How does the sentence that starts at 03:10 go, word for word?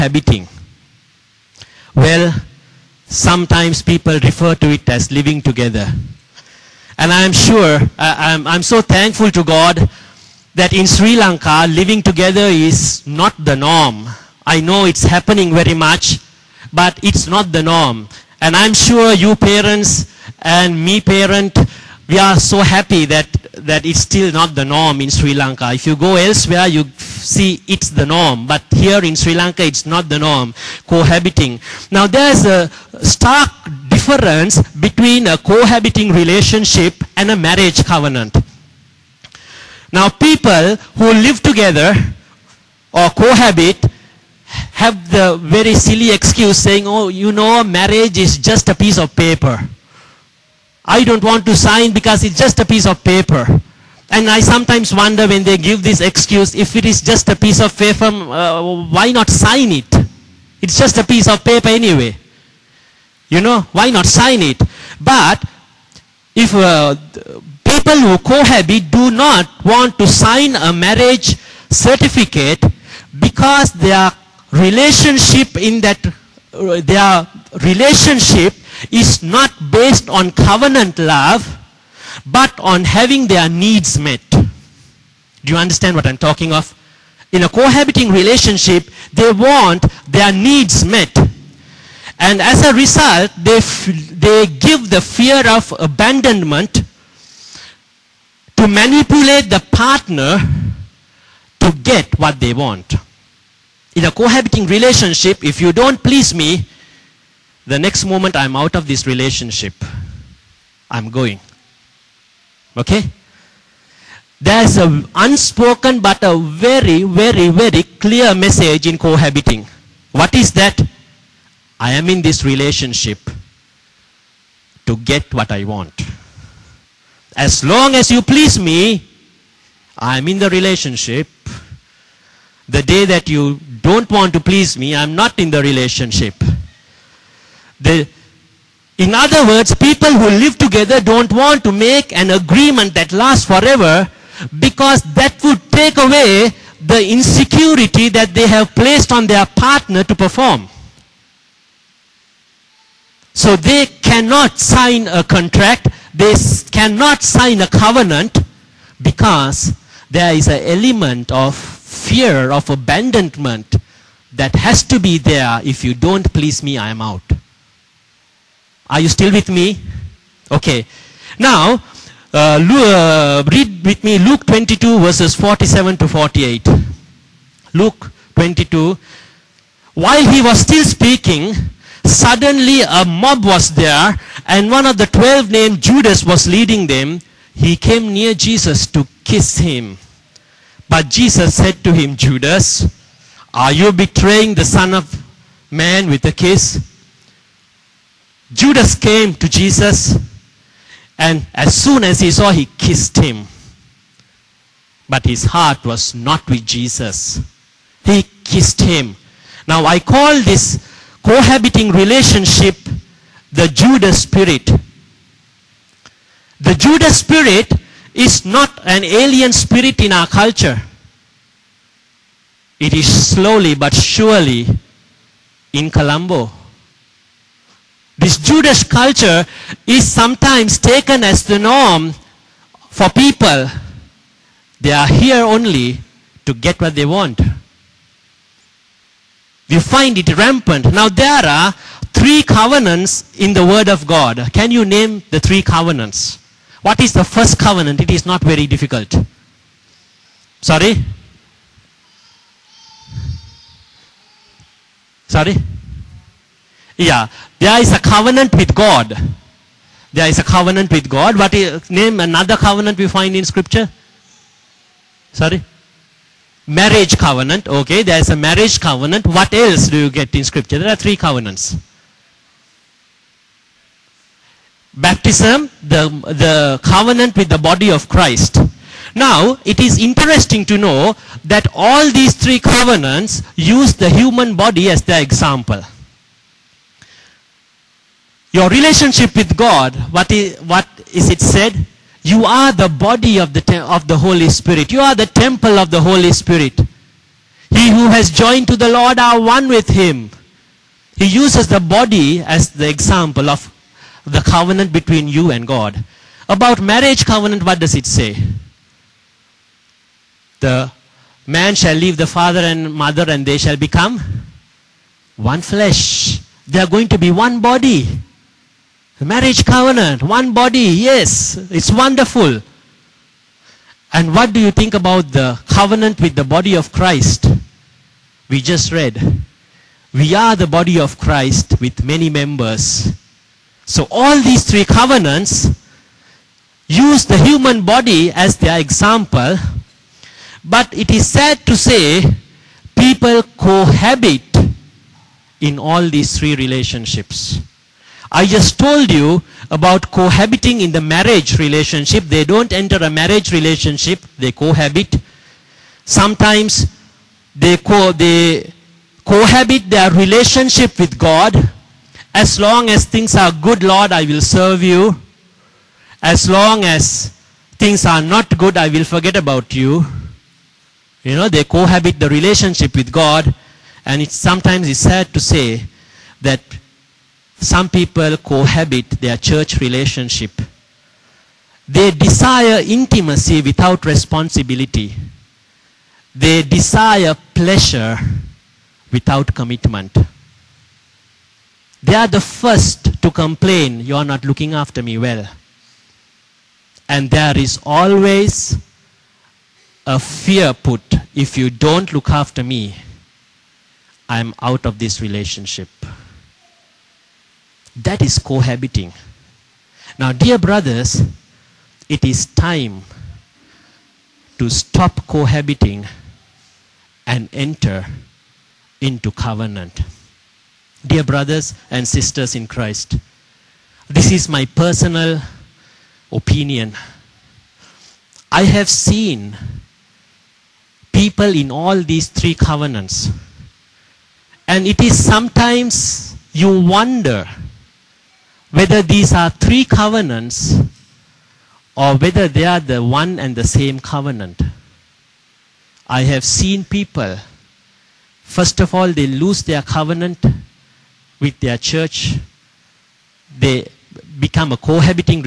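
But Jesus said to him, Judas, are you betraying the Son of Man with a kiss?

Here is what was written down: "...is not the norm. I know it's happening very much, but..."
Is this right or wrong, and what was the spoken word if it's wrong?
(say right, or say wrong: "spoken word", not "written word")
right.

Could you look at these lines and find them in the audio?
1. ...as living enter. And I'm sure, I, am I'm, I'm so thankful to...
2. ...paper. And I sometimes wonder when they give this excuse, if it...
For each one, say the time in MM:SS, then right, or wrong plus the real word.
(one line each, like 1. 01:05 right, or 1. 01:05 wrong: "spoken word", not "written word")
1. 00:04 wrong: "together", not "enter"
2. 00:53 right.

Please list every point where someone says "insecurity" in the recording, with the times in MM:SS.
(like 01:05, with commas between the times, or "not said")
02:27.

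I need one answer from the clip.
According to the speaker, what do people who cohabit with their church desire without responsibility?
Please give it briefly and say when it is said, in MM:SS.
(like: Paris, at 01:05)
Intimacy, at 06:22.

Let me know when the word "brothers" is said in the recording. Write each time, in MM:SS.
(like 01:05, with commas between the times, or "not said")
06:50, 07:01.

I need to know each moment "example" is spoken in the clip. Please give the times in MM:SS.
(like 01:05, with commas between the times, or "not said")
04:45, 05:02, 05:38.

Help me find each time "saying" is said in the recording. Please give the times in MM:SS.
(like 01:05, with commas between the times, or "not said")
00:46.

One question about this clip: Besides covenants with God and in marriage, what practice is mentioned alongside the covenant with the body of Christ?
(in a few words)
Baptism.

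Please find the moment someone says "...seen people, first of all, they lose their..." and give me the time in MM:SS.
07:26.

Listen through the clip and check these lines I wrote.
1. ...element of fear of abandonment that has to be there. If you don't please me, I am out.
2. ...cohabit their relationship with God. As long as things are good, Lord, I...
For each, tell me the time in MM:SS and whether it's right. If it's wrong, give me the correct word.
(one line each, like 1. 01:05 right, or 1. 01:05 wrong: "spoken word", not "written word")
1. 02:40 right
2. 05:59 right.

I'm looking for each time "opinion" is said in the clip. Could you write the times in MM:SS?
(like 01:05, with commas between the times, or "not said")
07:06.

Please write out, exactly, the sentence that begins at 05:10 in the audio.
The man shall leave the father and mother and they shall become one flesh.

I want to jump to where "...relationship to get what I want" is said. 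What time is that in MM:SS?
02:02.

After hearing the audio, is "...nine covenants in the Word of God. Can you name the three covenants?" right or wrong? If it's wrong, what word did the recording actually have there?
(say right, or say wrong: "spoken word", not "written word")
wrong: "three", not "nine".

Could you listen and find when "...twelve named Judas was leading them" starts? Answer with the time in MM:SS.
03:05.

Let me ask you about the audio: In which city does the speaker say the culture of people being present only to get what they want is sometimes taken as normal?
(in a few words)
Colombo.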